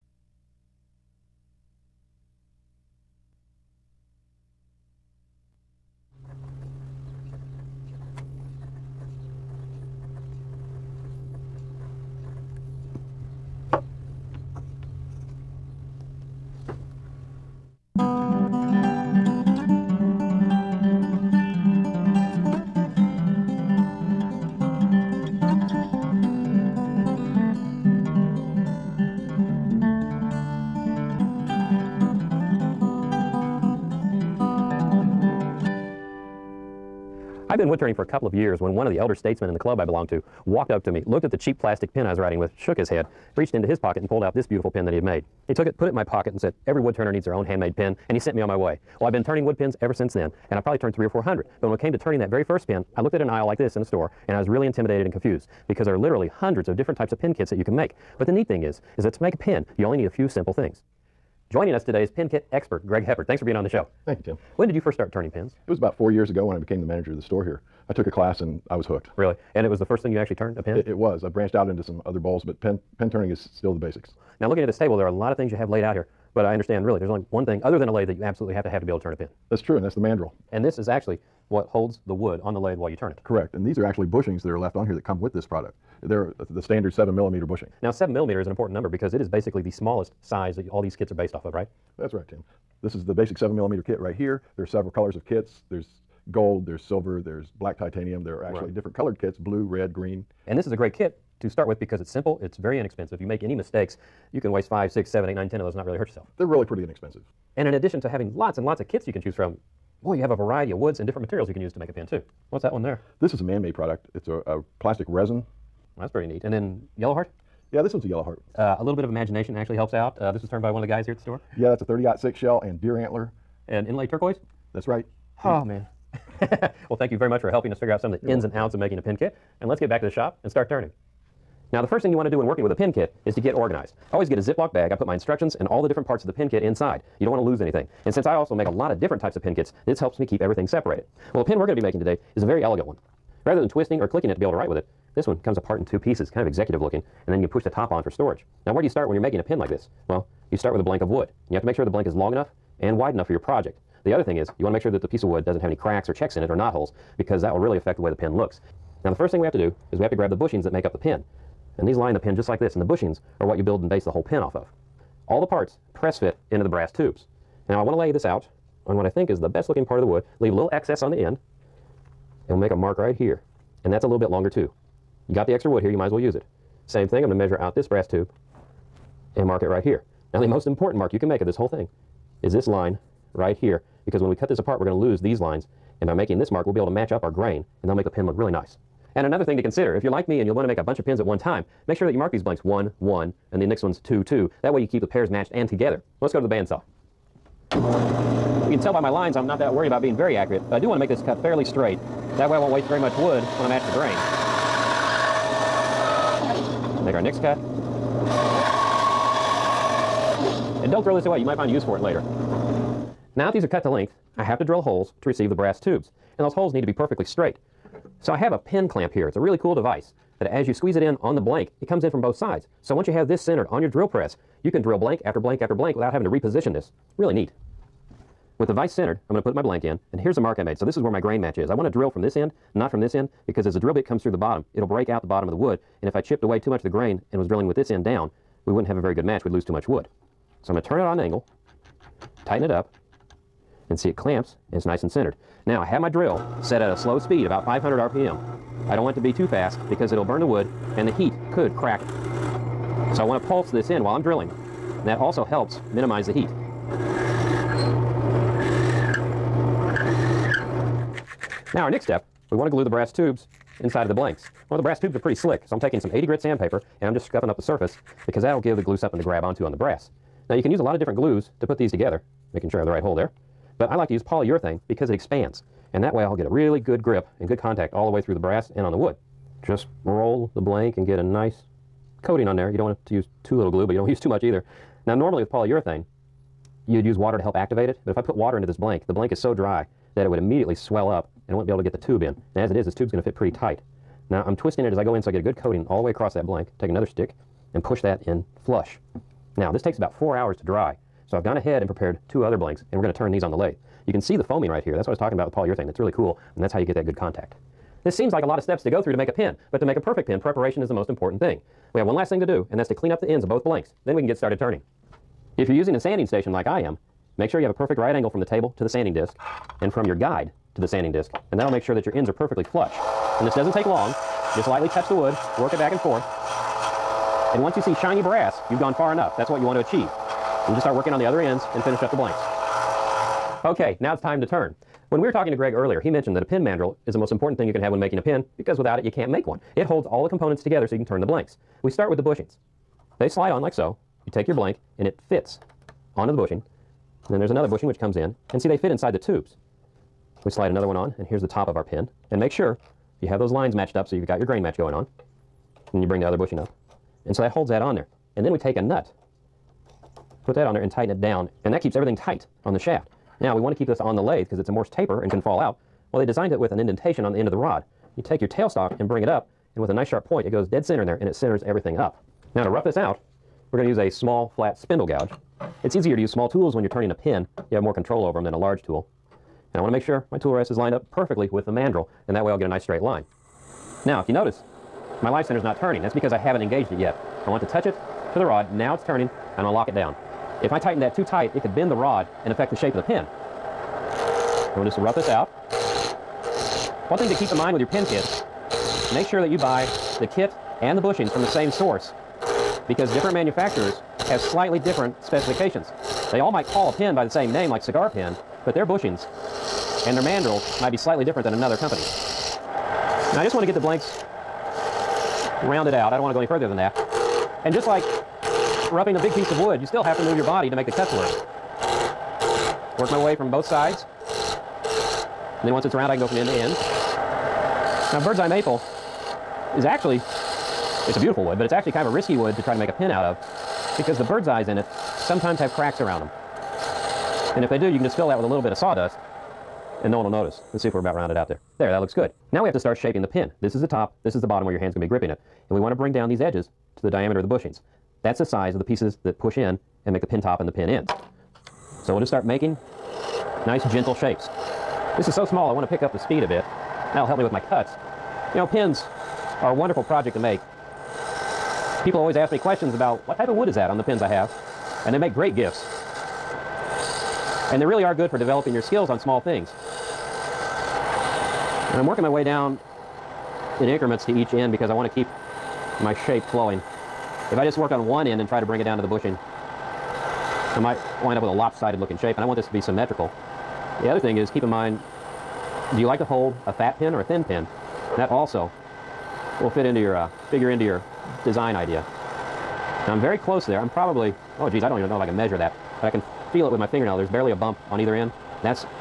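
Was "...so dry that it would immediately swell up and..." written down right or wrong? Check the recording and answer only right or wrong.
right.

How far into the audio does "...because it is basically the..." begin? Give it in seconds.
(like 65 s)
88 s.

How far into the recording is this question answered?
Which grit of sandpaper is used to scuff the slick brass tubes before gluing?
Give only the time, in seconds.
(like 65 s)
266 s.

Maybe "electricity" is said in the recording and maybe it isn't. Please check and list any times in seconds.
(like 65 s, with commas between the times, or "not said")
not said.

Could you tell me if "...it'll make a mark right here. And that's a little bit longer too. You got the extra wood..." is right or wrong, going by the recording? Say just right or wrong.
right.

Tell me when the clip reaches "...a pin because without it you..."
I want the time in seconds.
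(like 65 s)
338 s.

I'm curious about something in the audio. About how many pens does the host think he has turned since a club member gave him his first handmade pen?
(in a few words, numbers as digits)
300 or 400.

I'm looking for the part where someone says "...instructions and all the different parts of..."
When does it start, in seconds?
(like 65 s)
135 s.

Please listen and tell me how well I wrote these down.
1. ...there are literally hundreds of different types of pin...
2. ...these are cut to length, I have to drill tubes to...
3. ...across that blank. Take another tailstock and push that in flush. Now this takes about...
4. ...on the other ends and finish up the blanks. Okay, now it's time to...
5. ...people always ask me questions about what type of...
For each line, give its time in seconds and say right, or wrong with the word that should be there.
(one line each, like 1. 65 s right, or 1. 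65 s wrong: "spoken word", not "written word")
1. 55 s right
2. 213 s wrong: "holes", not "tubes"
3. 296 s wrong: "stick", not "tailstock"
4. 331 s right
5. 462 s right.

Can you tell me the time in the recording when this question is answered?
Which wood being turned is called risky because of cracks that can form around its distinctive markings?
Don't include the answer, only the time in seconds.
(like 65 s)
428 s.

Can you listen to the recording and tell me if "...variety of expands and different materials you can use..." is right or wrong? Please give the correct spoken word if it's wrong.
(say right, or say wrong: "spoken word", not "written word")
wrong: "woods", not "expands".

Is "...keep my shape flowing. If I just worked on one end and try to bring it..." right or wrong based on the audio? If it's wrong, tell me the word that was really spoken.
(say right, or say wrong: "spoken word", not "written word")
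right.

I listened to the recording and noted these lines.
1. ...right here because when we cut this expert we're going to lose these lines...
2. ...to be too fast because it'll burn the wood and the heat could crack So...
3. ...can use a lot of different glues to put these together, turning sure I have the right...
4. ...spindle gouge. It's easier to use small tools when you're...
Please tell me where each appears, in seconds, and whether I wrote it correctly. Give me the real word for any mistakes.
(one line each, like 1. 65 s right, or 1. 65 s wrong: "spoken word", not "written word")
1. 183 s wrong: "apart", not "expert"
2. 249 s right
3. 270 s wrong: "making", not "turning"
4. 374 s right.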